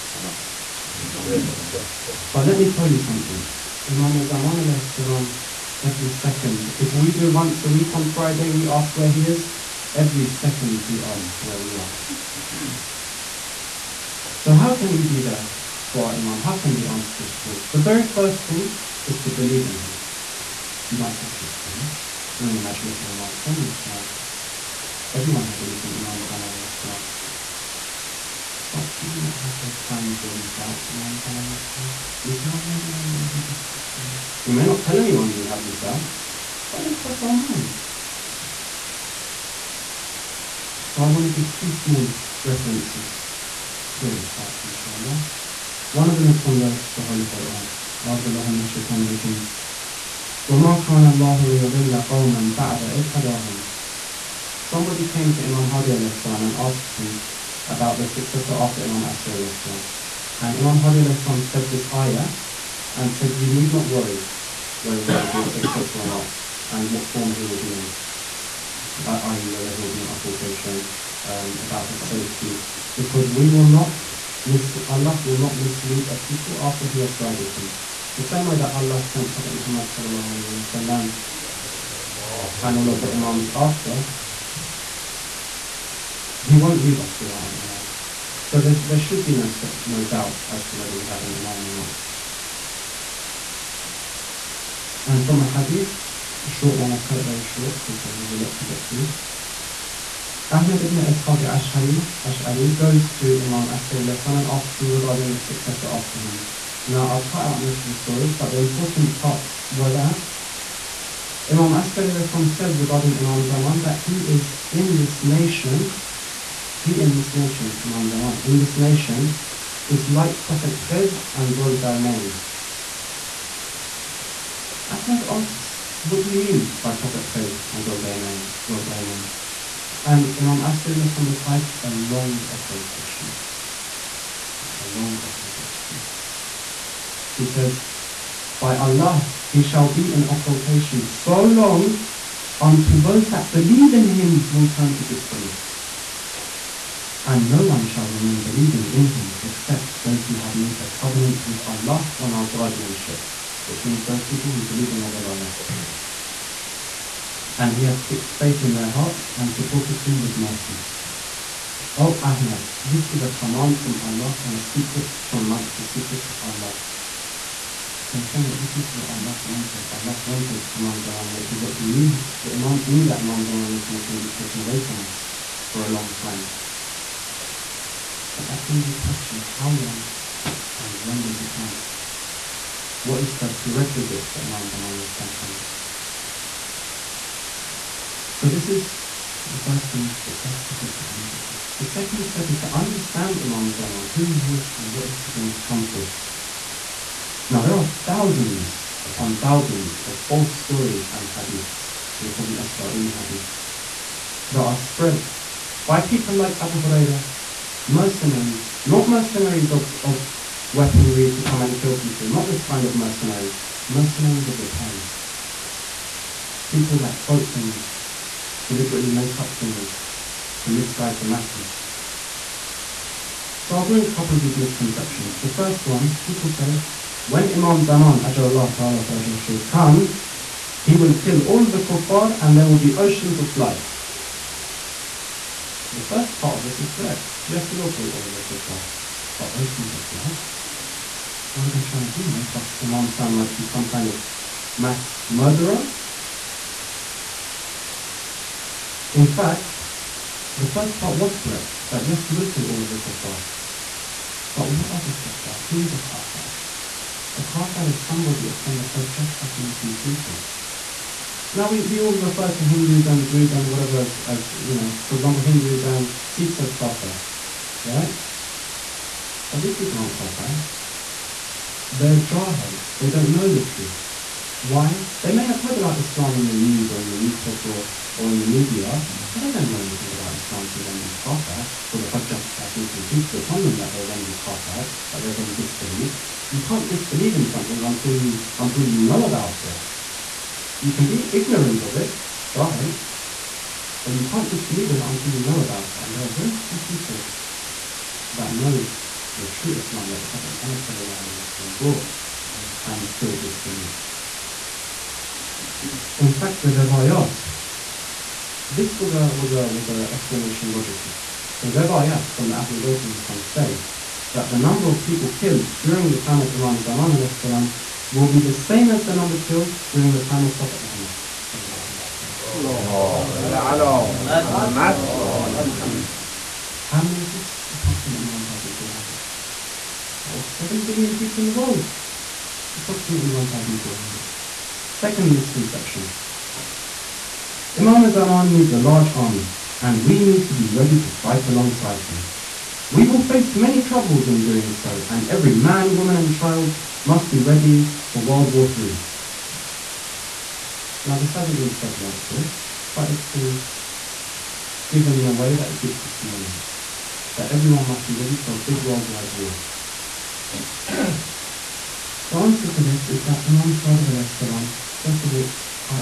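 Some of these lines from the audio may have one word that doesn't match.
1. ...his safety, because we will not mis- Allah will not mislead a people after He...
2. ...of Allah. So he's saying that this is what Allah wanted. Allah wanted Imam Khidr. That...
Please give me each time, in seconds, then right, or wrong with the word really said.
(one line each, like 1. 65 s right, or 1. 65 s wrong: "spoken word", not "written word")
1. 71 s right
2. 166 s wrong: "Zaman", not "Khidr".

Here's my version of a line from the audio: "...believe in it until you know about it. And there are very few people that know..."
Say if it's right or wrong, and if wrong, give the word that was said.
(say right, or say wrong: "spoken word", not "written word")
wrong: "disbelieve", not "believe".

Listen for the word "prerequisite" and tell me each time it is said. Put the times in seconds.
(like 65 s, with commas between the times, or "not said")
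183 s.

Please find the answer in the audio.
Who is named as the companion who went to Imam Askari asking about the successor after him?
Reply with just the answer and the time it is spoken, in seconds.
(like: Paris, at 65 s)
Ahmed ibn Ishaq Ash'ari, at 100 s.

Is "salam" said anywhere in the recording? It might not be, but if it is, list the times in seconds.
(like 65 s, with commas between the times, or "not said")
31 s, 317 s, 364 s.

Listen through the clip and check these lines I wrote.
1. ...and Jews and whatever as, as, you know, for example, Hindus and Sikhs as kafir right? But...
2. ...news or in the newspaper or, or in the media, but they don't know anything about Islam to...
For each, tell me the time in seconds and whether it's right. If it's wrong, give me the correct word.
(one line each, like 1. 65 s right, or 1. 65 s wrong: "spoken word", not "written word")
1. 263 s right
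2. 276 s right.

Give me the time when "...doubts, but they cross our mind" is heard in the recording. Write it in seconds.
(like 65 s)
35 s.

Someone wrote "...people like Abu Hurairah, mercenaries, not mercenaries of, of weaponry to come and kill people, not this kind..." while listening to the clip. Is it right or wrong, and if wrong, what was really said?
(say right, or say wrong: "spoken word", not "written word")
right.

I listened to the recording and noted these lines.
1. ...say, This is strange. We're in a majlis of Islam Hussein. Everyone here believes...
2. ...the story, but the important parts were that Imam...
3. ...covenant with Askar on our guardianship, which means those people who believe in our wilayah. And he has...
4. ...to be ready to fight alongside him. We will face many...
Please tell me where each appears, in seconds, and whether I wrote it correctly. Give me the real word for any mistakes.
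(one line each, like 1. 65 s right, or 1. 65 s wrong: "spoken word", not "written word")
1. 21 s wrong: "Imam", not "Islam"
2. 107 s right
3. 150 s wrong: "Allah", not "Askar"
4. 340 s right.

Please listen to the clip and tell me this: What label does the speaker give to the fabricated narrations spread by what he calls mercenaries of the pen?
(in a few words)
Israeli hadiths.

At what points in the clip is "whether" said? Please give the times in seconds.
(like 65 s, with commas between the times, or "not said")
64 s, 69 s, 90 s.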